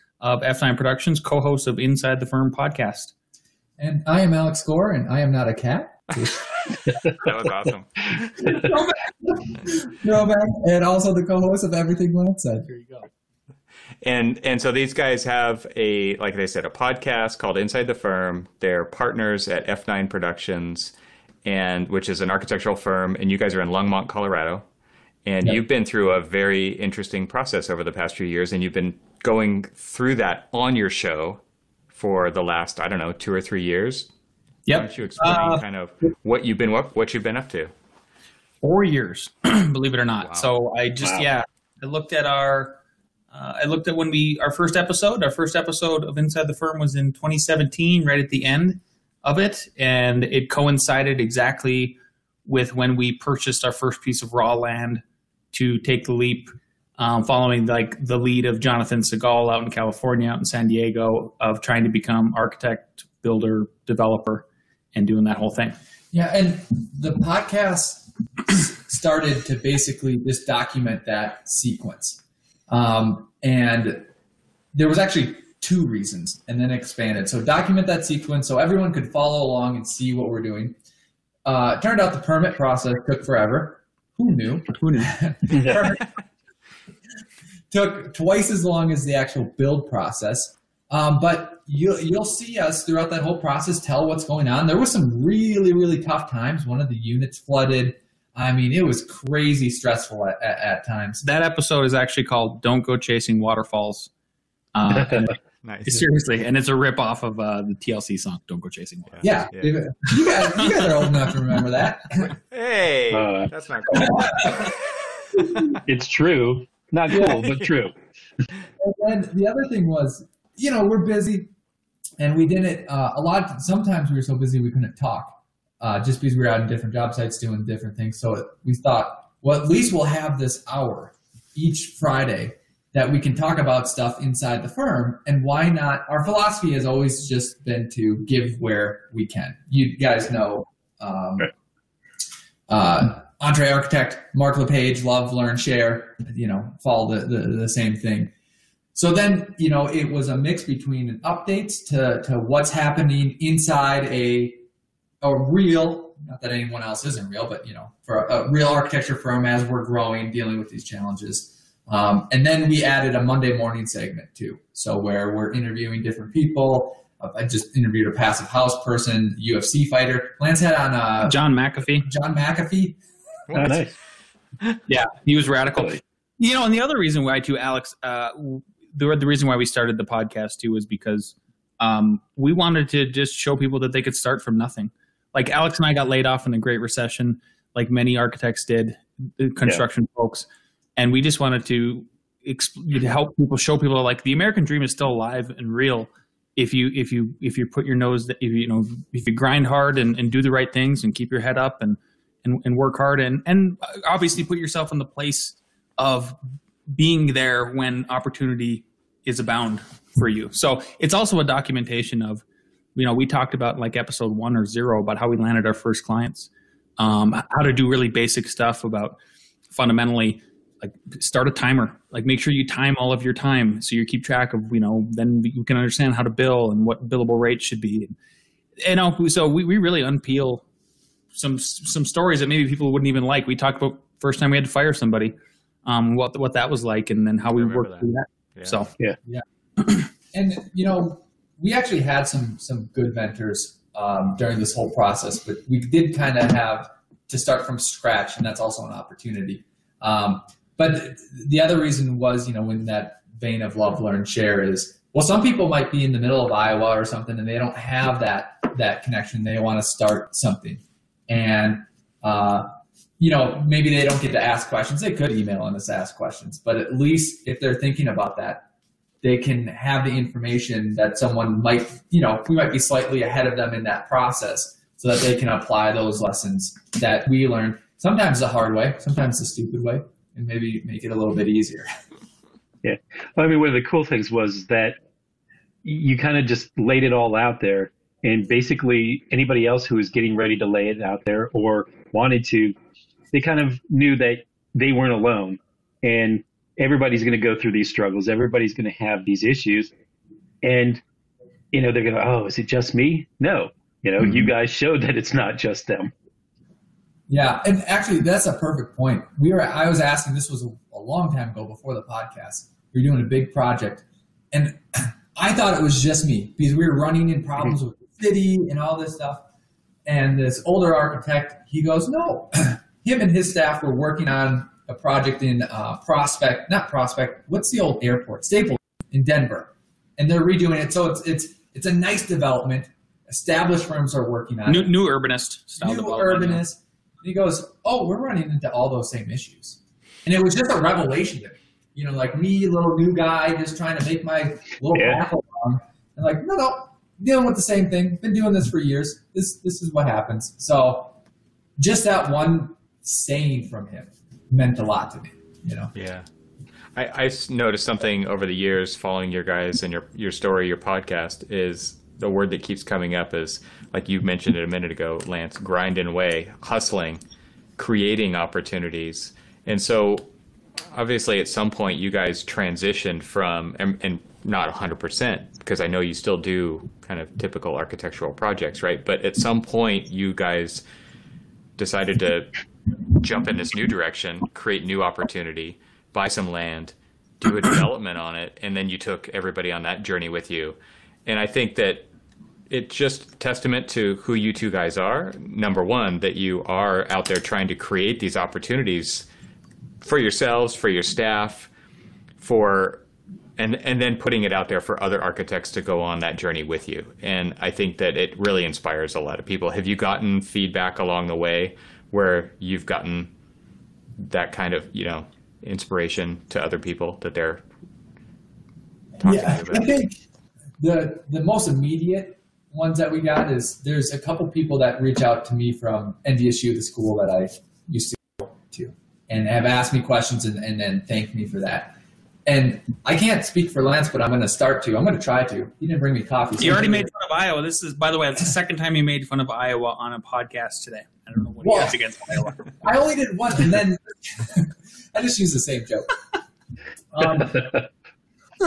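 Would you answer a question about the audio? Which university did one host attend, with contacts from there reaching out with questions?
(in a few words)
NDSU.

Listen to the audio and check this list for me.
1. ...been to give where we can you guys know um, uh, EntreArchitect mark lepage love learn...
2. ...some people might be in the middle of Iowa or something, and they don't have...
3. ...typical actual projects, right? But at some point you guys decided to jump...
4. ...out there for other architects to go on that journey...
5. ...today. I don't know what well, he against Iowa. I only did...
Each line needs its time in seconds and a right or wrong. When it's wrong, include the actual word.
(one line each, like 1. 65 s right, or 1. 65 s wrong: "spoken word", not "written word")
1. 137 s right
2. 255 s right
3. 377 s wrong: "architectural", not "actual"
4. 404 s right
5. 440 s right.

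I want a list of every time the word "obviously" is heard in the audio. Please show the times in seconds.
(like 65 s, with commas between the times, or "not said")
204 s, 370 s.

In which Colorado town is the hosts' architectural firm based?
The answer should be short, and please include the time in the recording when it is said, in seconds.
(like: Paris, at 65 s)
Longmont, at 23 s.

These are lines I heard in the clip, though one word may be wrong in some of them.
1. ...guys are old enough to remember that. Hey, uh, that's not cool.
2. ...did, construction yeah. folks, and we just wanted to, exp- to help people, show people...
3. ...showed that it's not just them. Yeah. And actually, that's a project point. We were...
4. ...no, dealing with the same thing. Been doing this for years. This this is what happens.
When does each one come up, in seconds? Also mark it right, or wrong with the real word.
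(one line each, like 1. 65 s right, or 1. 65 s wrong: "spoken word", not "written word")
1. 110 s right
2. 188 s right
3. 304 s wrong: "perfect", not "project"
4. 346 s right.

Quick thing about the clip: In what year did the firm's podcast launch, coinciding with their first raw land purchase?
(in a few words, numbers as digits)
2017.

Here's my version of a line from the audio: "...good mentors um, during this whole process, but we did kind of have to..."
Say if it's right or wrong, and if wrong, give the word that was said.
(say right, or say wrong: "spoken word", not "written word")
right.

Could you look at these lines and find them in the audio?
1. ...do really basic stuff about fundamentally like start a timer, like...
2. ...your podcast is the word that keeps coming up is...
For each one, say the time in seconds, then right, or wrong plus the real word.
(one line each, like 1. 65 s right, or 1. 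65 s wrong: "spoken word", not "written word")
1. 217 s right
2. 360 s right.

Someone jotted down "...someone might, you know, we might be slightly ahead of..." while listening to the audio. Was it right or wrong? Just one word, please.
right.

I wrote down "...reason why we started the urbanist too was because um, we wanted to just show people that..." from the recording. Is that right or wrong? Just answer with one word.
wrong.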